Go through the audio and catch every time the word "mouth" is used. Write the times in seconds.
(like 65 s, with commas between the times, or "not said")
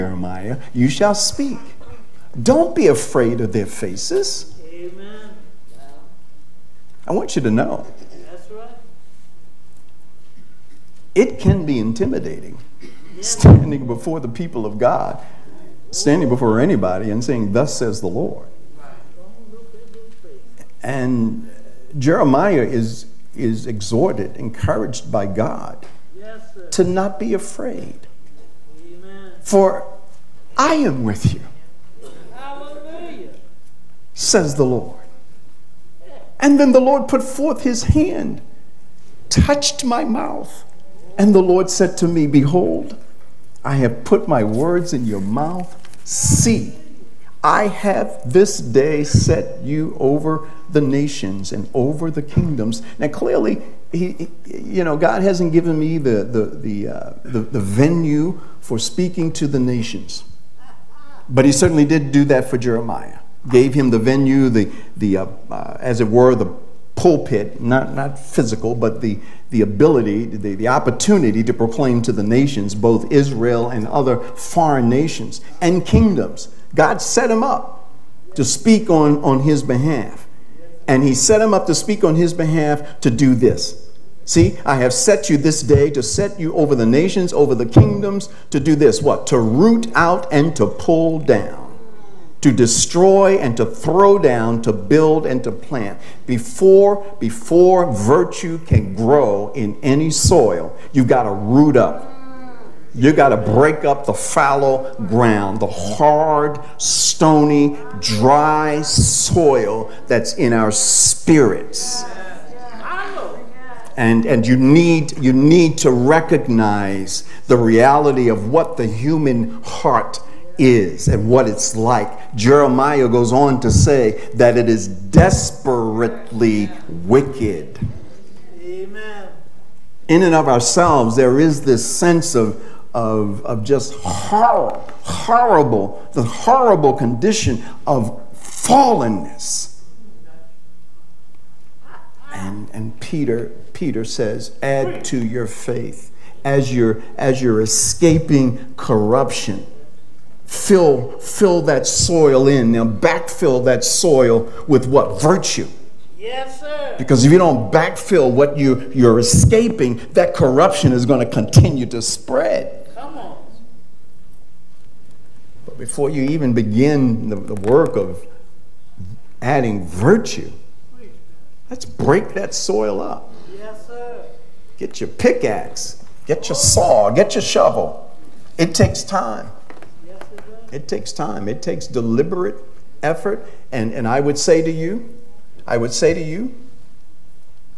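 40 s, 45 s.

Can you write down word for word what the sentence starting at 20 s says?
And Jeremiah is, is exhorted, encouraged by God to not be afraid for I am with you, says the Lord.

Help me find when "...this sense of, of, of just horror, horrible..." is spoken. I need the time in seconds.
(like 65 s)
131 s.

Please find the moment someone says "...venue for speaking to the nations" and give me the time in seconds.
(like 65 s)
57 s.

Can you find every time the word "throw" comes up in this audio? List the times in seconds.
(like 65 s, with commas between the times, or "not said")
93 s.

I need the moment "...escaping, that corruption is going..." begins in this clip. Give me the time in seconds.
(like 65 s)
159 s.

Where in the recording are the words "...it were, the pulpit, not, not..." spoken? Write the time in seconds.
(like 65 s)
65 s.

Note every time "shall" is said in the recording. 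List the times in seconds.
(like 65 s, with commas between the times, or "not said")
0 s.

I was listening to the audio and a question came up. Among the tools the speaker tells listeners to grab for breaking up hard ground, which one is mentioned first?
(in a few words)
Pickaxe.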